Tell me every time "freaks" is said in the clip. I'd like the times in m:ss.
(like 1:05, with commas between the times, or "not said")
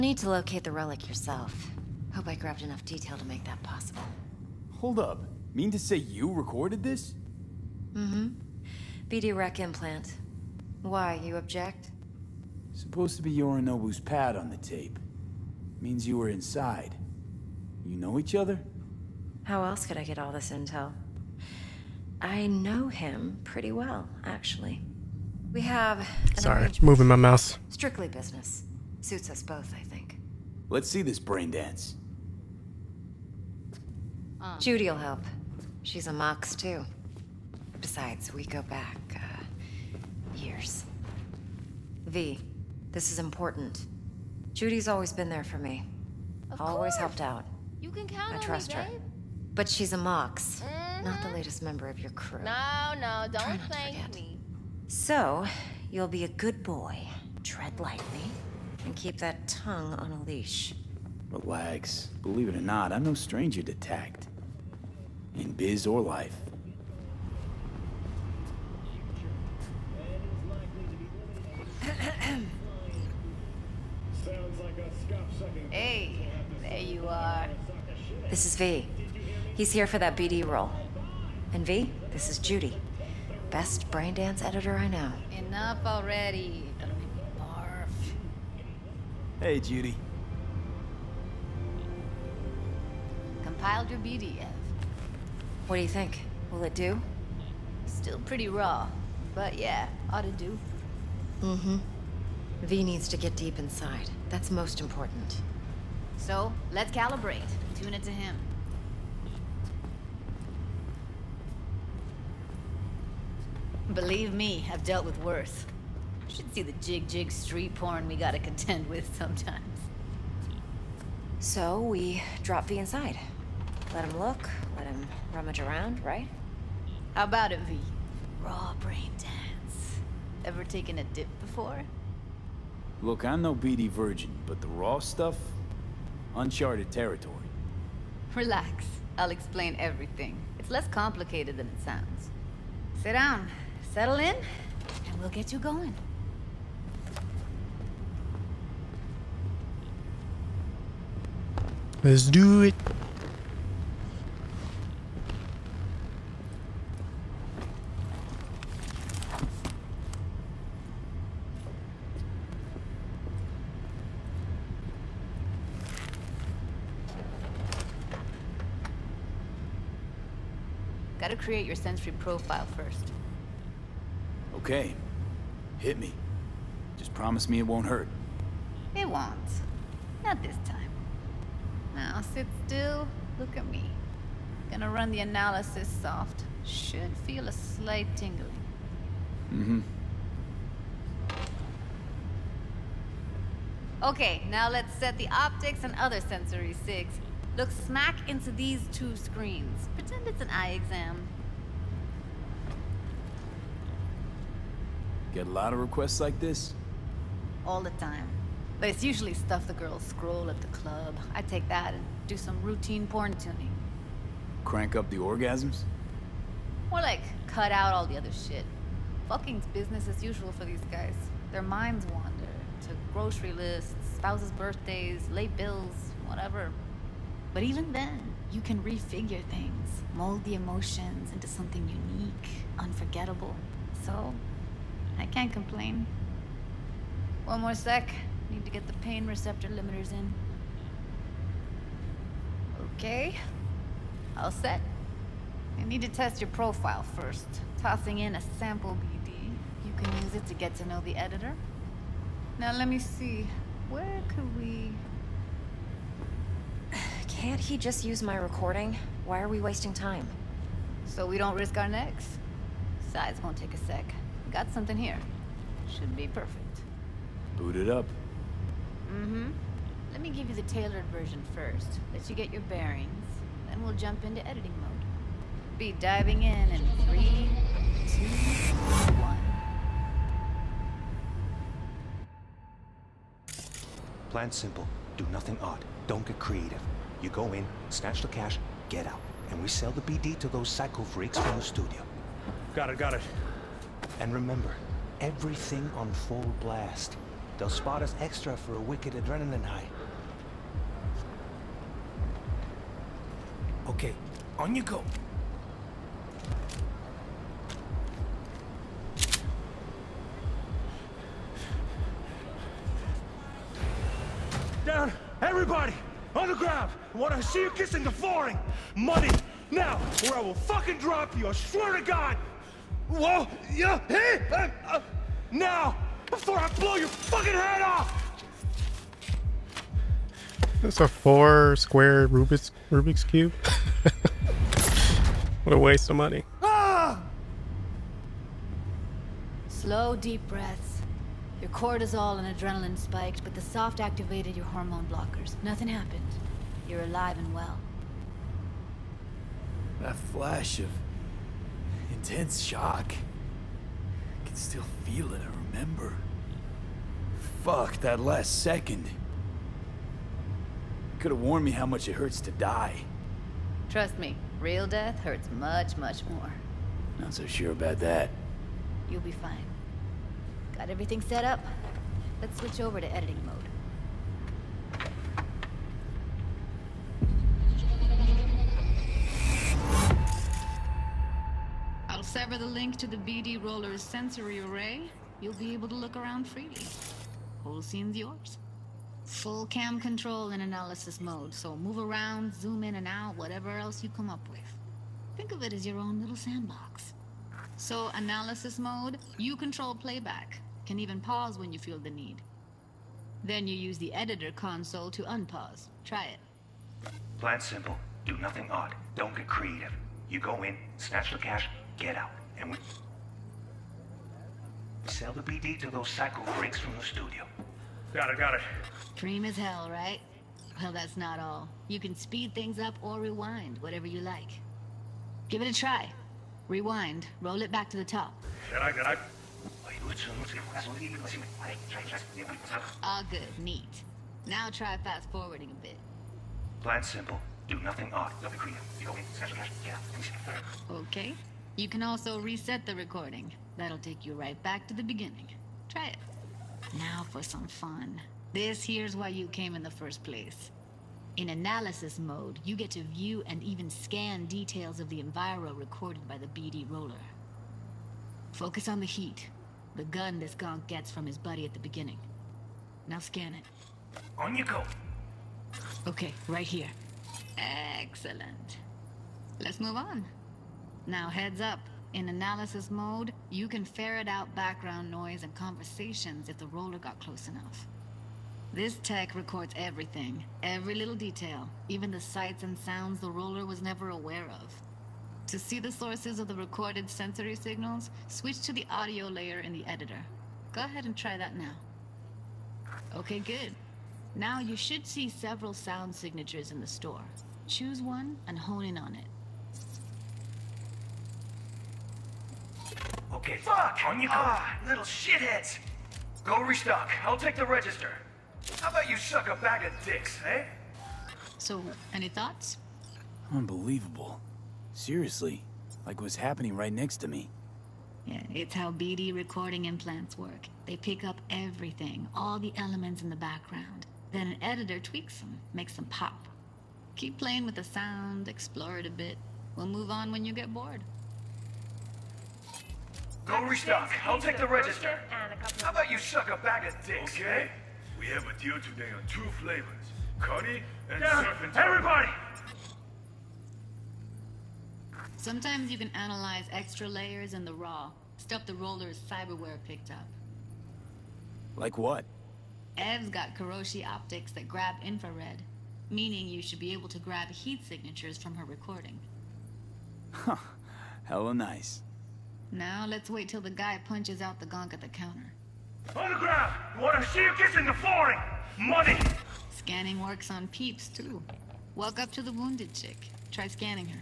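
4:51, 6:56.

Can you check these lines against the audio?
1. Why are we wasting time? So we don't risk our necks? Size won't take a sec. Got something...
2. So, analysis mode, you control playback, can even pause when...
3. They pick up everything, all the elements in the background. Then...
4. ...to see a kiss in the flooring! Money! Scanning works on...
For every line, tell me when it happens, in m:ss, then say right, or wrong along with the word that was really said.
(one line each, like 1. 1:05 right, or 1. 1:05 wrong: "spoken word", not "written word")
1. 4:19 right
2. 6:37 right
3. 8:40 right
4. 9:27 right.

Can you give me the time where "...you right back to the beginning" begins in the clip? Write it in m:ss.
7:24.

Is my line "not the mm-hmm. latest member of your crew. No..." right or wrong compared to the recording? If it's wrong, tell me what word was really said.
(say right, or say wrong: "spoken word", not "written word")
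right.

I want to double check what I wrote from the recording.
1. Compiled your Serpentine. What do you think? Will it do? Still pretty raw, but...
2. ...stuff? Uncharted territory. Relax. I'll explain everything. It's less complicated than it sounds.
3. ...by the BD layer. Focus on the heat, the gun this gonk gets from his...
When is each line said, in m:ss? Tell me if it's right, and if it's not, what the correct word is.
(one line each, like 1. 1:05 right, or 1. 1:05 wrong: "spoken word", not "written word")
1. 1:33 wrong: "BDF", not "Serpentine"
2. 2:14 right
3. 7:36 wrong: "roller", not "layer".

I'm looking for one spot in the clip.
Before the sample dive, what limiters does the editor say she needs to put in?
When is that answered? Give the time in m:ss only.
3:59.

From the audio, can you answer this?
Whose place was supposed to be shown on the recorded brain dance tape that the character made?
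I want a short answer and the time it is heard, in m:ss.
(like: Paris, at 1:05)
Yorinobu, at 0:13.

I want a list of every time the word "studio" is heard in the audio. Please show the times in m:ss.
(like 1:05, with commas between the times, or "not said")
4:51, 6:57.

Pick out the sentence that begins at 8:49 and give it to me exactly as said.
We'll move on when you get bored.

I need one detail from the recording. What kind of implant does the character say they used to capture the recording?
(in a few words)
BD rec implant.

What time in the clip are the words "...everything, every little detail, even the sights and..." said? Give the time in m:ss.
7:59.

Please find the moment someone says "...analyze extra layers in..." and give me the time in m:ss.
9:06.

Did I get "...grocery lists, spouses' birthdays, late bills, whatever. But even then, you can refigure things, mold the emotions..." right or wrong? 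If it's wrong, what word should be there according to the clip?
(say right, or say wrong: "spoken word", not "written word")
right.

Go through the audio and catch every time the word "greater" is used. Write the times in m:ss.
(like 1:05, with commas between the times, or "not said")
not said.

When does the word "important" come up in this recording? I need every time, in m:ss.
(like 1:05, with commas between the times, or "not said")
0:43, 1:44.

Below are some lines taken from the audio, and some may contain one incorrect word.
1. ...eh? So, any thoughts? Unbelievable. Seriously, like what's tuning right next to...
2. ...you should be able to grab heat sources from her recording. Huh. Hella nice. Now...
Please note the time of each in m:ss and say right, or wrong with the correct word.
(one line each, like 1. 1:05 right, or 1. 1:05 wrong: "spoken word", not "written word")
1. 8:30 wrong: "happening", not "tuning"
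2. 9:16 wrong: "signatures", not "sources".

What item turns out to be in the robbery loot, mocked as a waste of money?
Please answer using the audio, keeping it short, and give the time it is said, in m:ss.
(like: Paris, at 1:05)
Rubik's cube, at 5:32.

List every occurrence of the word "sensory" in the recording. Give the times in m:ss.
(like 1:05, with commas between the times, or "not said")
2:51, 3:16, 6:24, 8:07.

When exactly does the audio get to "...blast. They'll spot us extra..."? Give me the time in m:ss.
4:56.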